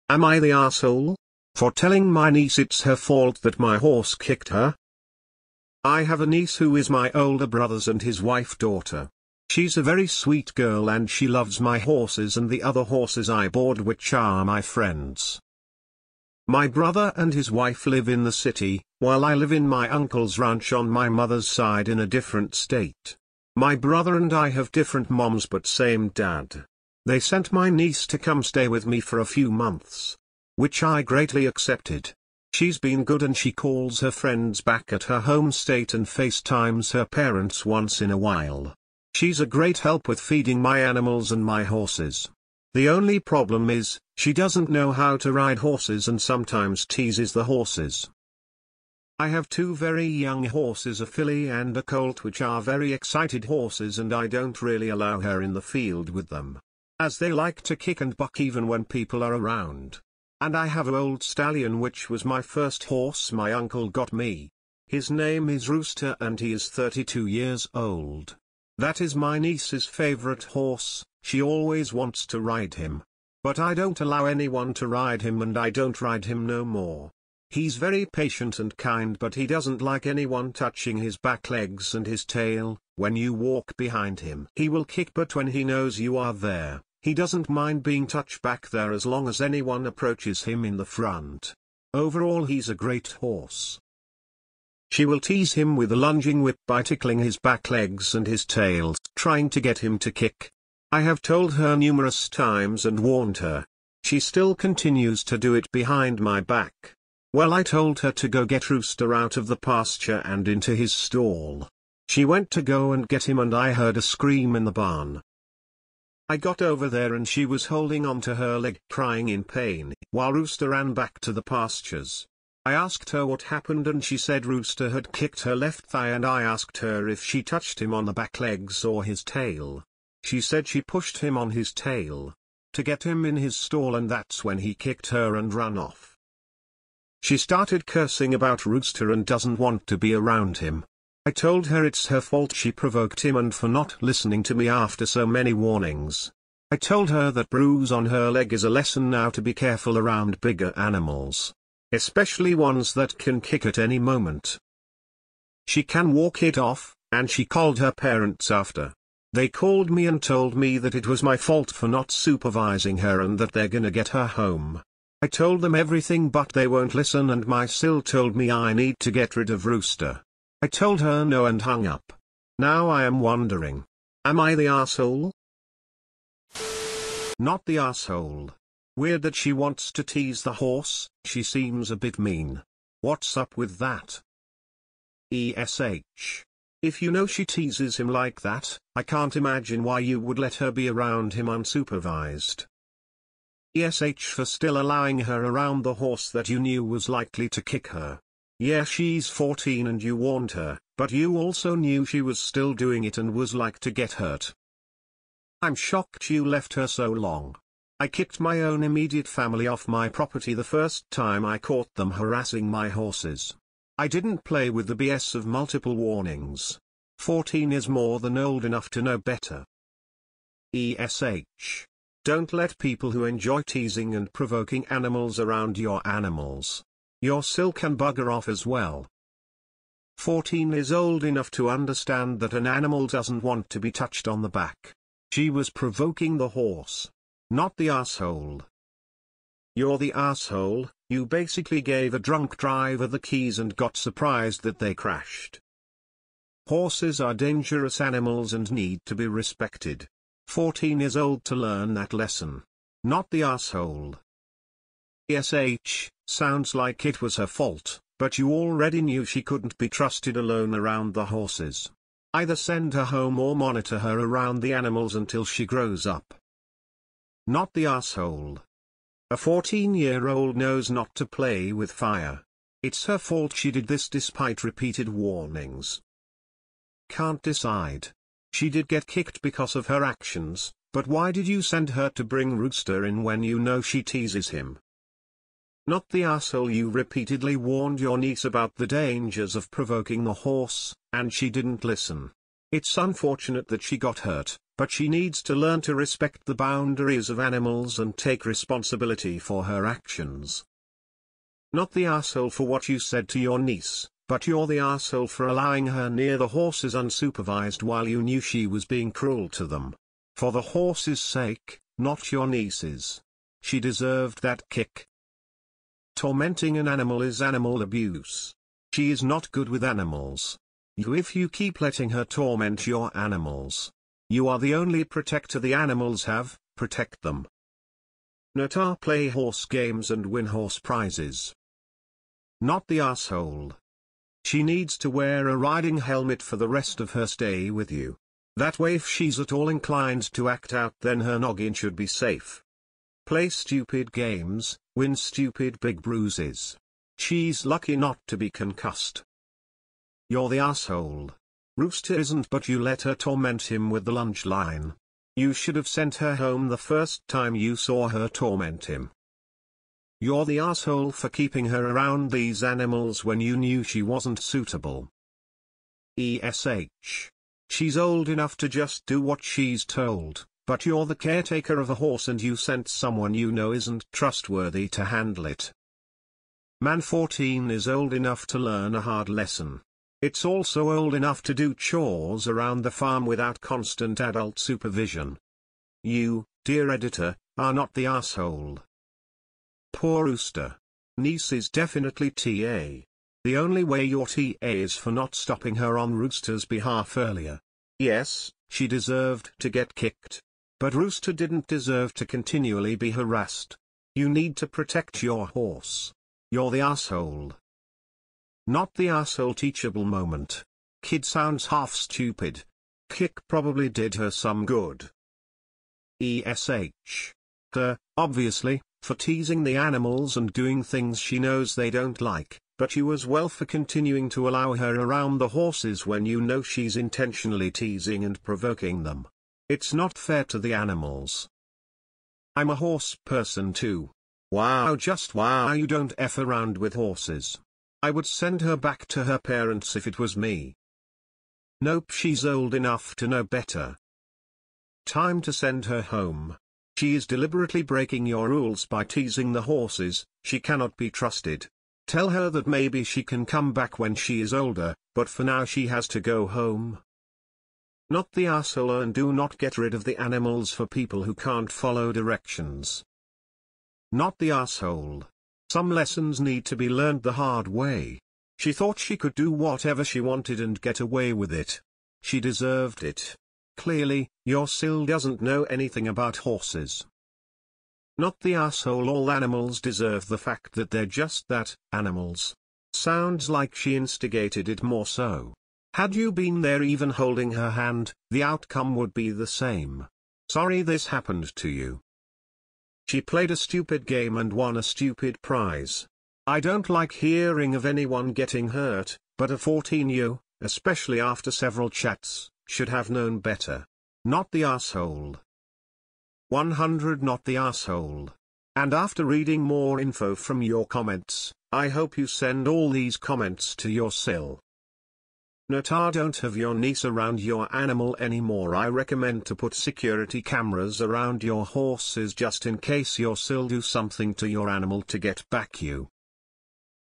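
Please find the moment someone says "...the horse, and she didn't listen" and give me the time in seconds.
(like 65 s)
290 s.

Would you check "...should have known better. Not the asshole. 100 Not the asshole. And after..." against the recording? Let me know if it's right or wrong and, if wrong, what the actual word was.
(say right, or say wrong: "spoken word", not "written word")
right.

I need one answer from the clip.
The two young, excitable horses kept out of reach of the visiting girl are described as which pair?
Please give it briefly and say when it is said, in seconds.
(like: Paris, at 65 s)
A filly and a colt, at 51 s.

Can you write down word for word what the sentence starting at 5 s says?
I have a niece who is my older brother's and his wife daughter.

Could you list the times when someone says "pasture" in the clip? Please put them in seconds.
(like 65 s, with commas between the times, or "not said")
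109 s, 121 s.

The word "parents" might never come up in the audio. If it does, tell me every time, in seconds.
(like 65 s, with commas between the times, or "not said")
37 s, 157 s, 439 s.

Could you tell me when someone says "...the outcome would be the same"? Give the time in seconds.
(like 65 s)
488 s.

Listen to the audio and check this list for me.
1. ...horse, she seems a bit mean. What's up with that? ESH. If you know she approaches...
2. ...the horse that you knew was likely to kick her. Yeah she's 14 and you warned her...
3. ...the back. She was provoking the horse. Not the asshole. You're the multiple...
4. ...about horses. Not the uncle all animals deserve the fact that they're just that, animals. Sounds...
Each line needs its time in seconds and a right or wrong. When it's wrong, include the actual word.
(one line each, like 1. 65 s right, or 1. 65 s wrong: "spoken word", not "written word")
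1. 180 s wrong: "teases", not "approaches"
2. 195 s right
3. 234 s wrong: "asshole", not "multiple"
4. 476 s wrong: "asshole", not "uncle".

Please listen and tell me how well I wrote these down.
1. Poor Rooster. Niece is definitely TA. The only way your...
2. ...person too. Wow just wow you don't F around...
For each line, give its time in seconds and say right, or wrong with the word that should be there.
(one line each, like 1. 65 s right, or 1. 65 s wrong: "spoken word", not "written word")
1. 389 s right
2. 433 s right.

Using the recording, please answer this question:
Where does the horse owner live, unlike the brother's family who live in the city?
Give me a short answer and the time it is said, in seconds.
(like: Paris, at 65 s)
Uncle's ranch, at 19 s.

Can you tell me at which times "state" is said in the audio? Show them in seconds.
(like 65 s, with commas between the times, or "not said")
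22 s, 35 s.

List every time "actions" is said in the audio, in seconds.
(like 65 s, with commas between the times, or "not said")
280 s, 299 s.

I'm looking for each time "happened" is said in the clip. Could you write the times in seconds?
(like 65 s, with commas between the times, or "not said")
123 s, 491 s.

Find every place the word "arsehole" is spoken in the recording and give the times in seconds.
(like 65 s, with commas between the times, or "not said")
458 s, 464 s.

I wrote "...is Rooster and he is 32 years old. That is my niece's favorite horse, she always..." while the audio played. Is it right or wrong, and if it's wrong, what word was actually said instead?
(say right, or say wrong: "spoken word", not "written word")
right.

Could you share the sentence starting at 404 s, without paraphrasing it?
You need to protect your horse.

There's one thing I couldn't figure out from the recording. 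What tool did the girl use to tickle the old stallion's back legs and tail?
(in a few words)
Lunging whip.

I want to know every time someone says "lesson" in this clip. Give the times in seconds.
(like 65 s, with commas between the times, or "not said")
148 s, 252 s, 379 s, 465 s.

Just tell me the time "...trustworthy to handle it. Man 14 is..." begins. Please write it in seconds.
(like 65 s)
374 s.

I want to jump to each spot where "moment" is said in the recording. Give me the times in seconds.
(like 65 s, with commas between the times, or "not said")
153 s, 410 s.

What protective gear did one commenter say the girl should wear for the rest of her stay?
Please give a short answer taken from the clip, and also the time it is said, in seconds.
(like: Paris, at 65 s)
Riding helmet, at 335 s.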